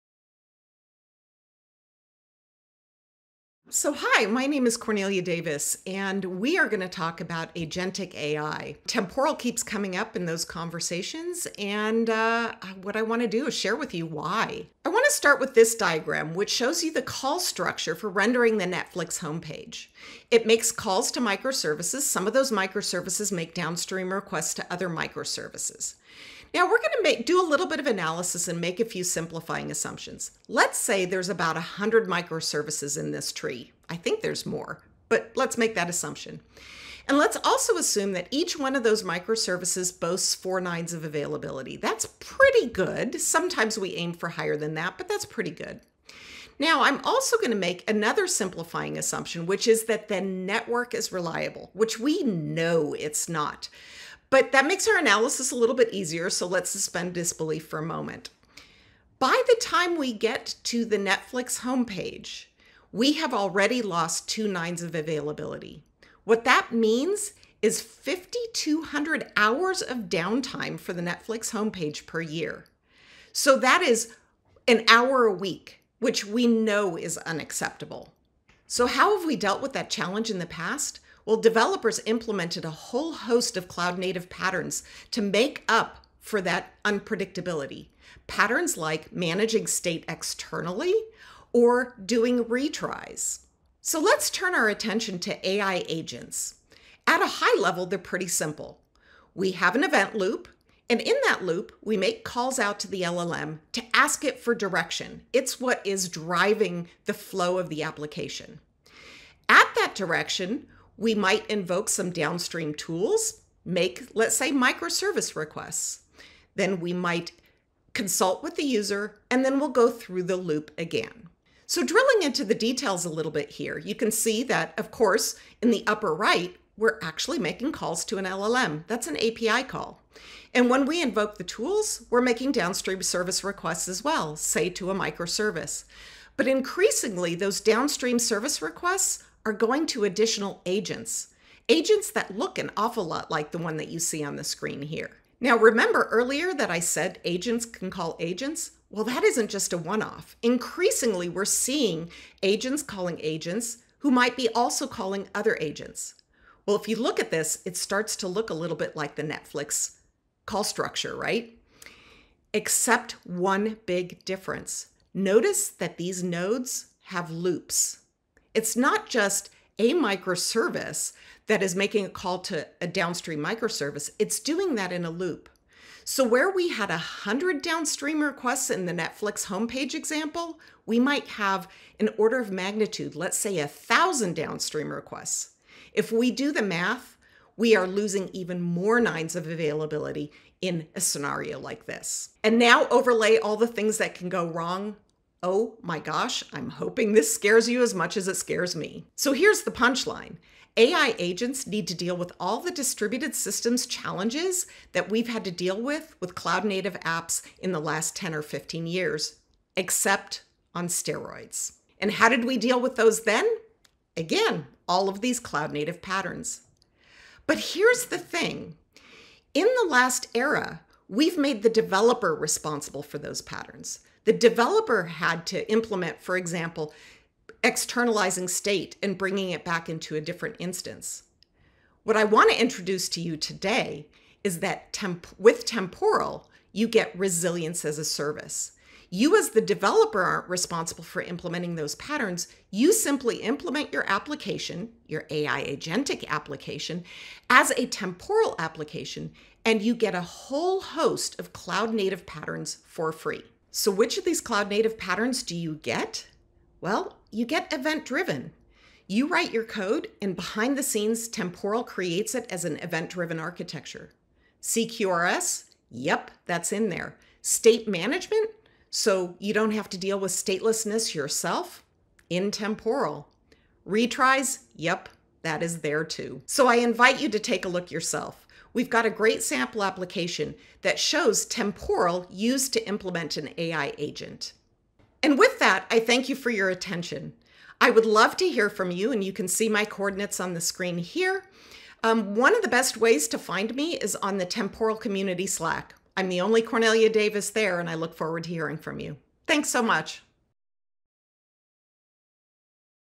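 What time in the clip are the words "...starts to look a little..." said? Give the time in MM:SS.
02:37.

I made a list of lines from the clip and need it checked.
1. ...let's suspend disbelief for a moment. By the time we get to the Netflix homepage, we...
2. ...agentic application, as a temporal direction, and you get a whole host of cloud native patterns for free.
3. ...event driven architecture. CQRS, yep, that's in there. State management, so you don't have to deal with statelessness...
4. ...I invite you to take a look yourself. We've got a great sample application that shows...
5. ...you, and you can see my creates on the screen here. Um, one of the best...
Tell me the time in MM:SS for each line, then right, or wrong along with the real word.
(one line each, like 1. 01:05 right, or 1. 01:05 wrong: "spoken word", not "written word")
1. 00:56 right
2. 04:05 wrong: "application", not "direction"
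3. 04:22 right
4. 04:36 right
5. 04:48 wrong: "coordinates", not "creates".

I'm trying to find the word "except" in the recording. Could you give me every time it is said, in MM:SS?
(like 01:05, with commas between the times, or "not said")
02:42, 03:29.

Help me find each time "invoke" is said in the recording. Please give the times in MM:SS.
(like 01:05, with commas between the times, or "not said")
01:51, 02:11.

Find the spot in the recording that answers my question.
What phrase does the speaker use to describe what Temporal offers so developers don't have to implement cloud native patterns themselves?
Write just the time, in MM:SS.
03:57.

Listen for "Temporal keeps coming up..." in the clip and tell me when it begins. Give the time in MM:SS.
00:08.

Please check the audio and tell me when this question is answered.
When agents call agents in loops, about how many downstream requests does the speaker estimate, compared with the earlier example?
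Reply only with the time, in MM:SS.
03:03.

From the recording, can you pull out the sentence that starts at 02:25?
Now, remember earlier that I said agents can call agents?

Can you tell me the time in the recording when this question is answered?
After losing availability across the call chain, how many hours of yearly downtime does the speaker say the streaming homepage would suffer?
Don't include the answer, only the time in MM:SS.
01:07.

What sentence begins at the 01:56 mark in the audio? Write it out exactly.
Then we might consult with the user, and then we'll go through the loop again.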